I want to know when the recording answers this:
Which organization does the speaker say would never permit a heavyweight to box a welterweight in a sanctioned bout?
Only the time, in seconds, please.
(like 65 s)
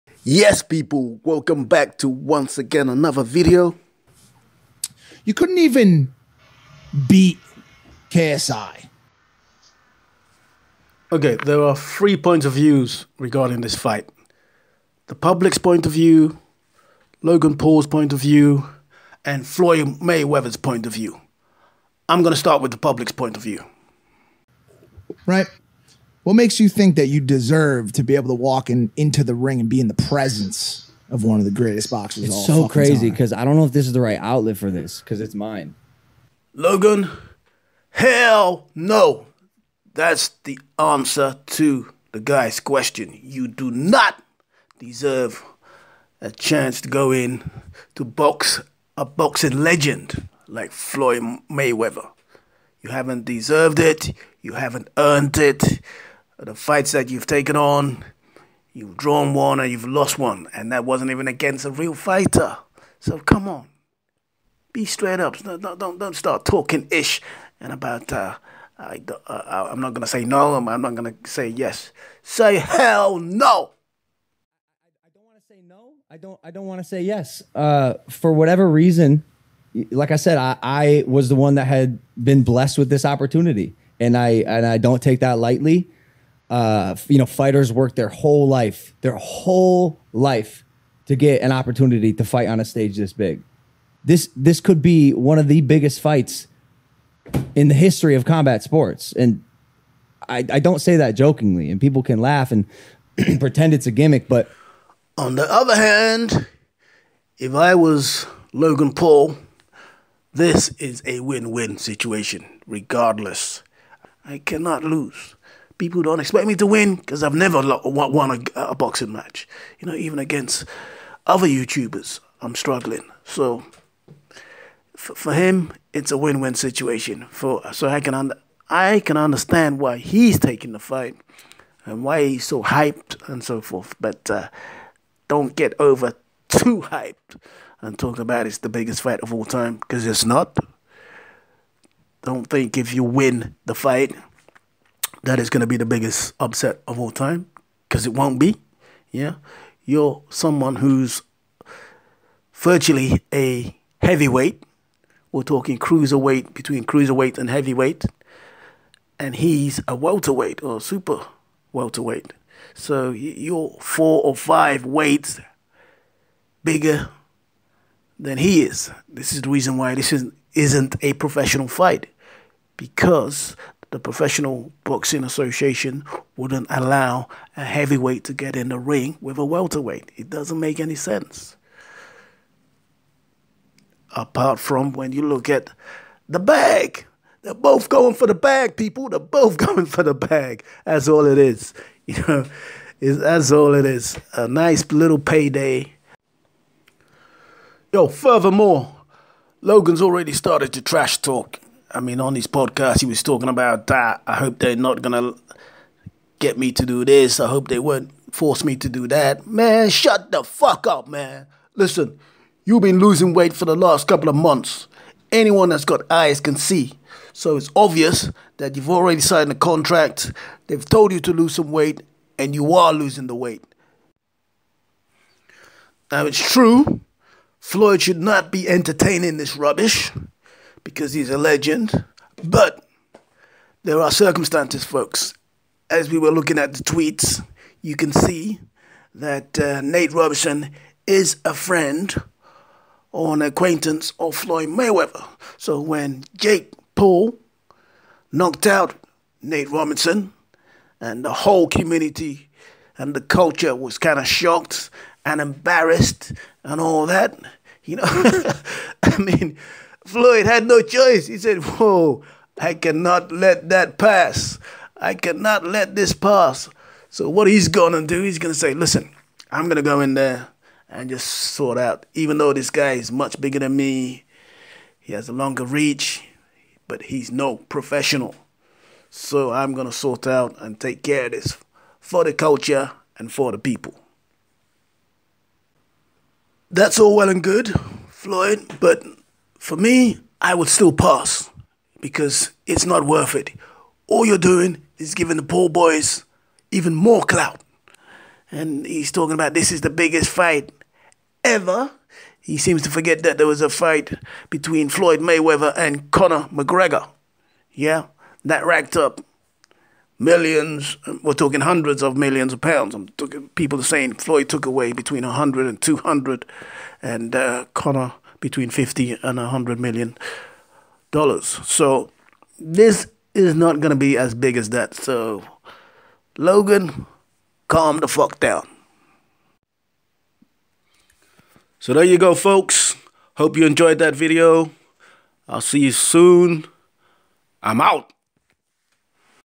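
173 s.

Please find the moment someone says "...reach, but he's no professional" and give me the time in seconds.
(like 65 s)
275 s.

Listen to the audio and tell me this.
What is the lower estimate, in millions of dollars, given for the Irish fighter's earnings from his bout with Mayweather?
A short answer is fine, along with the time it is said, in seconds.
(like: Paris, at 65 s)
50, at 318 s.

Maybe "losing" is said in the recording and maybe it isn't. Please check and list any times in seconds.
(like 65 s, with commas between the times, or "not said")
212 s, 222 s.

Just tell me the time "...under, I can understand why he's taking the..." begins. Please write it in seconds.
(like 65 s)
128 s.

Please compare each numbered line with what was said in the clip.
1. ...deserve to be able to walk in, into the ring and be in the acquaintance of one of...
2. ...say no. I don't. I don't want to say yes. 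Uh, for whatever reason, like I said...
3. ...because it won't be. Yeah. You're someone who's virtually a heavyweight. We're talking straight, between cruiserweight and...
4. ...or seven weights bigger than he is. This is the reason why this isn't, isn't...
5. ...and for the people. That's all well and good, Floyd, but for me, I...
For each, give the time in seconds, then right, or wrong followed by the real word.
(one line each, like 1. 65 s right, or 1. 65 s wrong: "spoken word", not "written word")
1. 27 s wrong: "presence", not "acquaintance"
2. 75 s right
3. 147 s wrong: "cruiserweight", not "straight"
4. 164 s wrong: "five", not "seven"
5. 283 s right.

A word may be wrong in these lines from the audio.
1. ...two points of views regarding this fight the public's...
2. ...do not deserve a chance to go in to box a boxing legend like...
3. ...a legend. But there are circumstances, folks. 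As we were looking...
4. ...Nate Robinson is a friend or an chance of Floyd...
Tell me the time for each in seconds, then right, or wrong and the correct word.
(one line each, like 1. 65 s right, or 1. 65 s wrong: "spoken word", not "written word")
1. 11 s wrong: "three", not "two"
2. 43 s right
3. 231 s right
4. 239 s wrong: "acquaintance", not "chance".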